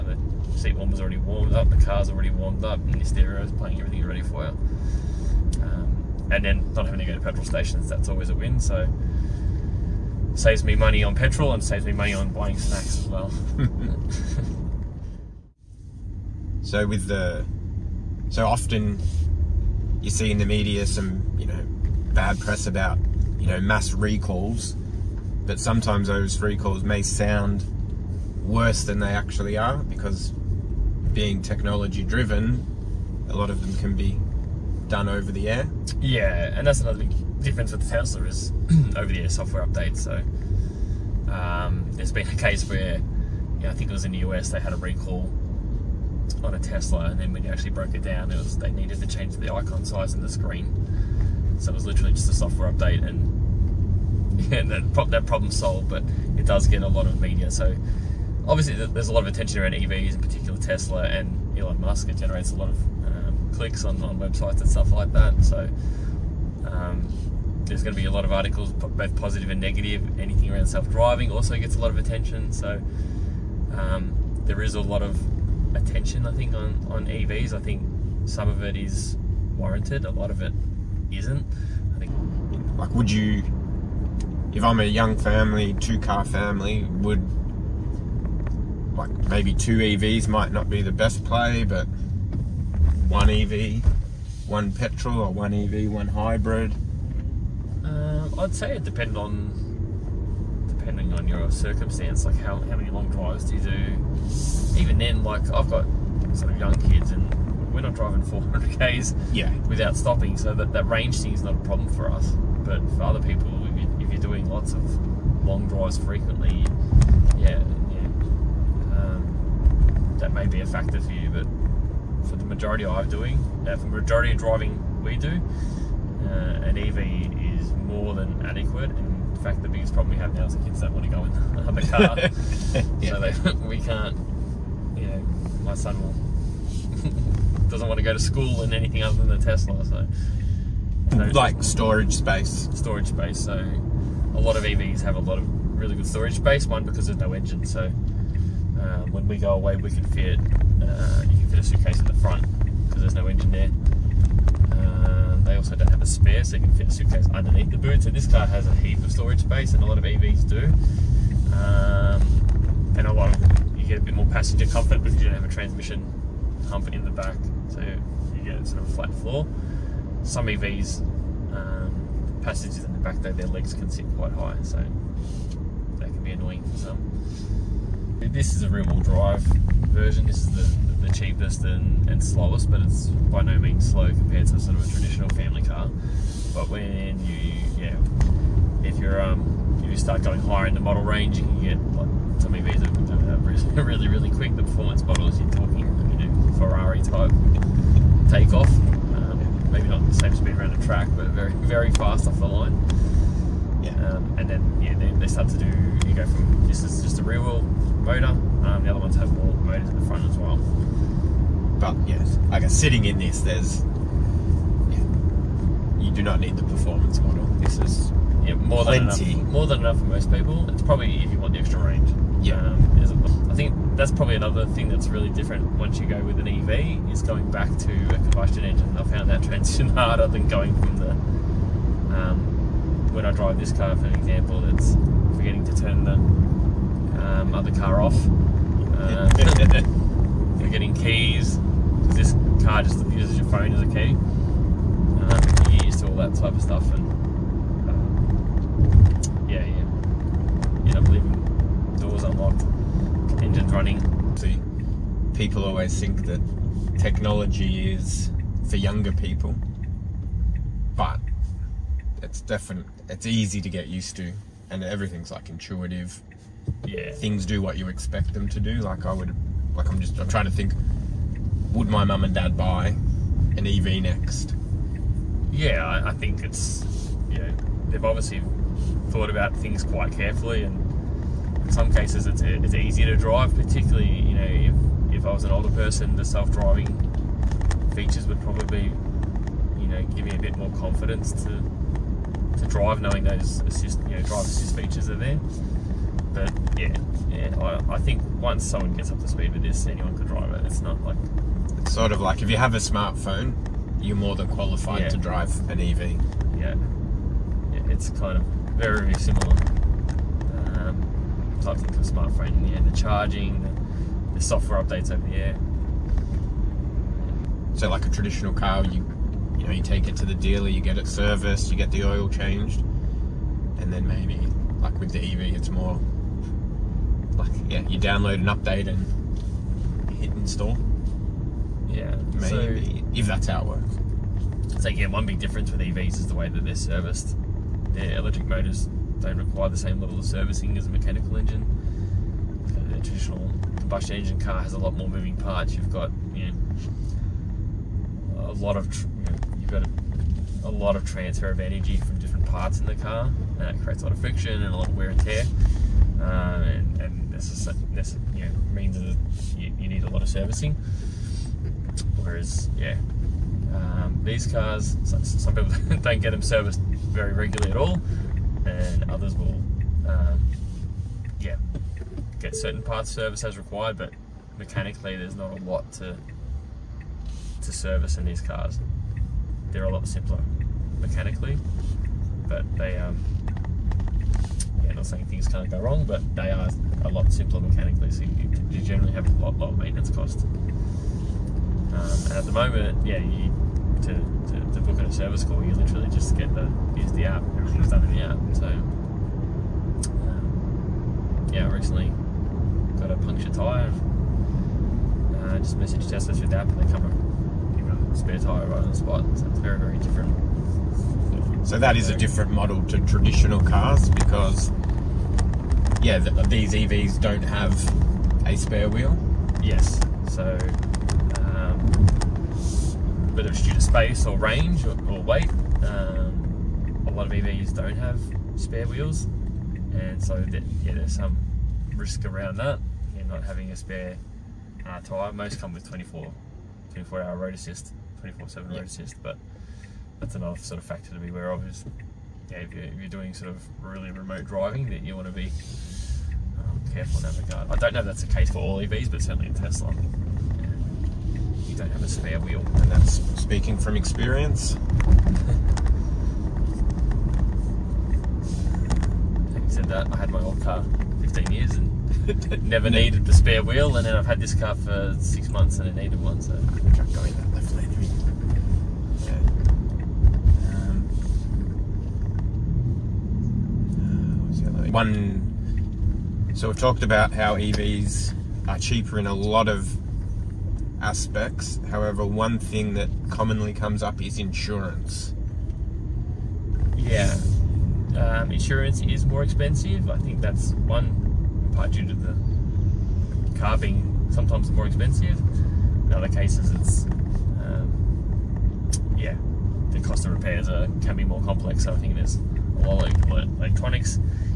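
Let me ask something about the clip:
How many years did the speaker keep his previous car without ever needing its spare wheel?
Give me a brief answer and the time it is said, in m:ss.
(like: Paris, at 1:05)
15, at 7:41.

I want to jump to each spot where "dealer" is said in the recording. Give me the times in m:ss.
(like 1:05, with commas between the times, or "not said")
5:20.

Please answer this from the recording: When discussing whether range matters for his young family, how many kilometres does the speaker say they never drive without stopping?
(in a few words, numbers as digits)
400.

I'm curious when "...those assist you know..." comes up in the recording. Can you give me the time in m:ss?
4:53.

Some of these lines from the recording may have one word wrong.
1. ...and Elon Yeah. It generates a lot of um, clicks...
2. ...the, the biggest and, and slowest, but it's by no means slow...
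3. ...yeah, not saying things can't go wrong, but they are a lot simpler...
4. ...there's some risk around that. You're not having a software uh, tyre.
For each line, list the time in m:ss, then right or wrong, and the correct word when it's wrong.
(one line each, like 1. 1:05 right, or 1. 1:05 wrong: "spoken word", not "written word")
1. 1:01 wrong: "Musk", not "Yeah"
2. 3:00 wrong: "cheapest", not "biggest"
3. 6:24 right
4. 7:10 wrong: "spare", not "software".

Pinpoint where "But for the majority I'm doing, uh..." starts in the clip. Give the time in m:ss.
2:01.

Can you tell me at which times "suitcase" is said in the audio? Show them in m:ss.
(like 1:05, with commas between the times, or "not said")
2:31, 2:36.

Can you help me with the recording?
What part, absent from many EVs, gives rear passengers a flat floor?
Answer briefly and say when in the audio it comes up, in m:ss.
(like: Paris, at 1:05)
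transmission hump, at 2:45.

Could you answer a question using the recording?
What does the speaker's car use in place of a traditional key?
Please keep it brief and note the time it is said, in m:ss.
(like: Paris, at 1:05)
your phone, at 4:03.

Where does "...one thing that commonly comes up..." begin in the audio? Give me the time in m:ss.
8:02.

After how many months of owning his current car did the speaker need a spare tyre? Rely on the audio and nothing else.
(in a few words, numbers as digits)
six.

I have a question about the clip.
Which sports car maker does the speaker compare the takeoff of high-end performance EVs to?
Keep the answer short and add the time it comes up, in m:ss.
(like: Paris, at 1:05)
Ferrari, at 3:16.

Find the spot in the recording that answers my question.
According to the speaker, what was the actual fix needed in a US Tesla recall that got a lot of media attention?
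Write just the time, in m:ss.
0:49.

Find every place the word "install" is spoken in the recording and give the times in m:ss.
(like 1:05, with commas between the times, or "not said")
5:30.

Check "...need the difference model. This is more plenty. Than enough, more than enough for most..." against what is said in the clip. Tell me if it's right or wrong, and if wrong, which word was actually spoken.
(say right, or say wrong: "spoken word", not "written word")
wrong: "performance", not "difference".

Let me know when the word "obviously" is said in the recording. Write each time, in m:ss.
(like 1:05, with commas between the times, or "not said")
0:58, 4:38.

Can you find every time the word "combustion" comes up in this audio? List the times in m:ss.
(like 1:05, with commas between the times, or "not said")
3:48, 5:43.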